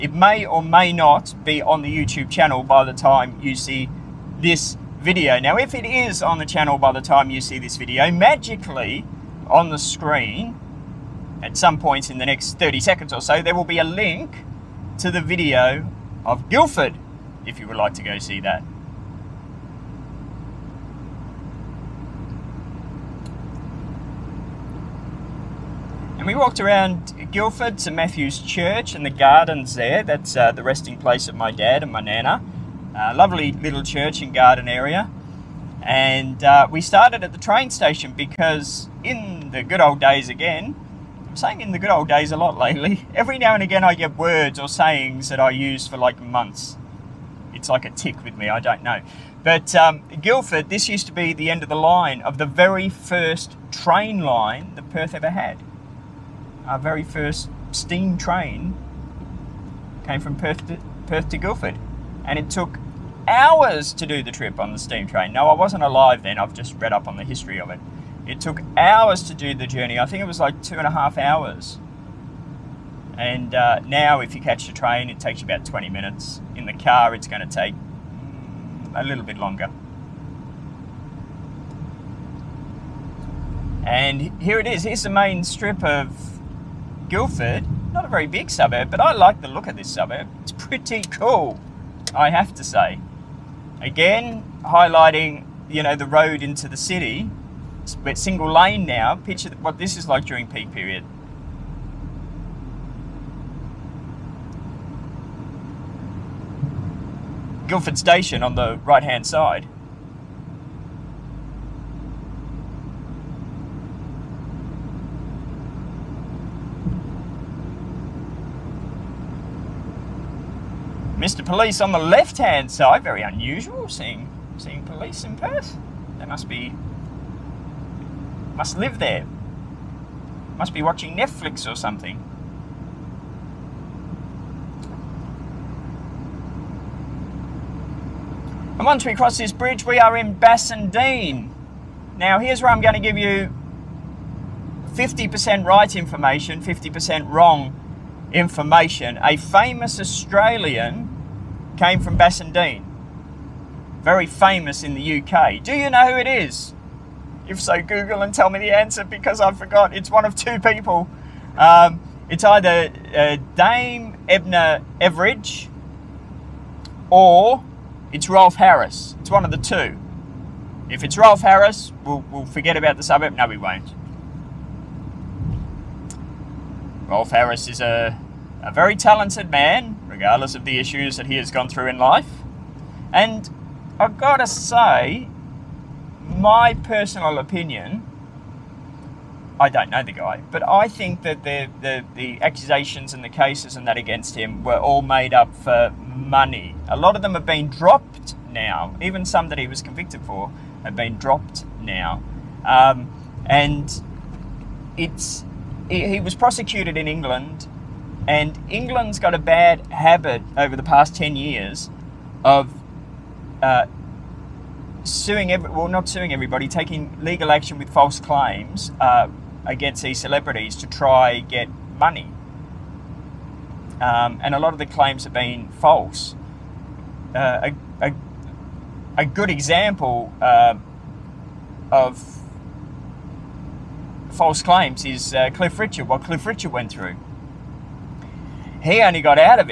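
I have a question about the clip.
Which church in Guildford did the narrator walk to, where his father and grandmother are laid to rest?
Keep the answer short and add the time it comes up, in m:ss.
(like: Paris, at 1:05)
Matthew's Church, at 0:27.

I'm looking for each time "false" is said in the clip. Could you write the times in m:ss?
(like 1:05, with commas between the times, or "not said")
3:37, 3:45, 3:54.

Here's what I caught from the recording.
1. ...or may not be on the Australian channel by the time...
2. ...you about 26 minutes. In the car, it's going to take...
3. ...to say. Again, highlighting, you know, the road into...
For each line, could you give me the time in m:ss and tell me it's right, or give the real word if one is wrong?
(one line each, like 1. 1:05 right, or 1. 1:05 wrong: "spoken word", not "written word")
1. 0:00 wrong: "YouTube", not "Australian"
2. 1:15 wrong: "20", not "26"
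3. 1:32 right.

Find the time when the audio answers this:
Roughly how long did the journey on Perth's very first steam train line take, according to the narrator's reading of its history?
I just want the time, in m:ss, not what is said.
1:10.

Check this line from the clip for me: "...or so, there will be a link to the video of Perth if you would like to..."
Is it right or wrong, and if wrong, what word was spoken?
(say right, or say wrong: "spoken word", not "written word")
wrong: "Guildford", not "Perth".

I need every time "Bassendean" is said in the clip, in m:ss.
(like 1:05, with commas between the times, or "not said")
2:20, 2:32.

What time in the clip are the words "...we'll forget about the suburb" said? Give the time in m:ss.
2:52.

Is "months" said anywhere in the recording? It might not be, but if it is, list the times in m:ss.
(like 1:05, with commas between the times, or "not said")
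0:46.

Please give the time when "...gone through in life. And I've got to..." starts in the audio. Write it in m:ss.
3:01.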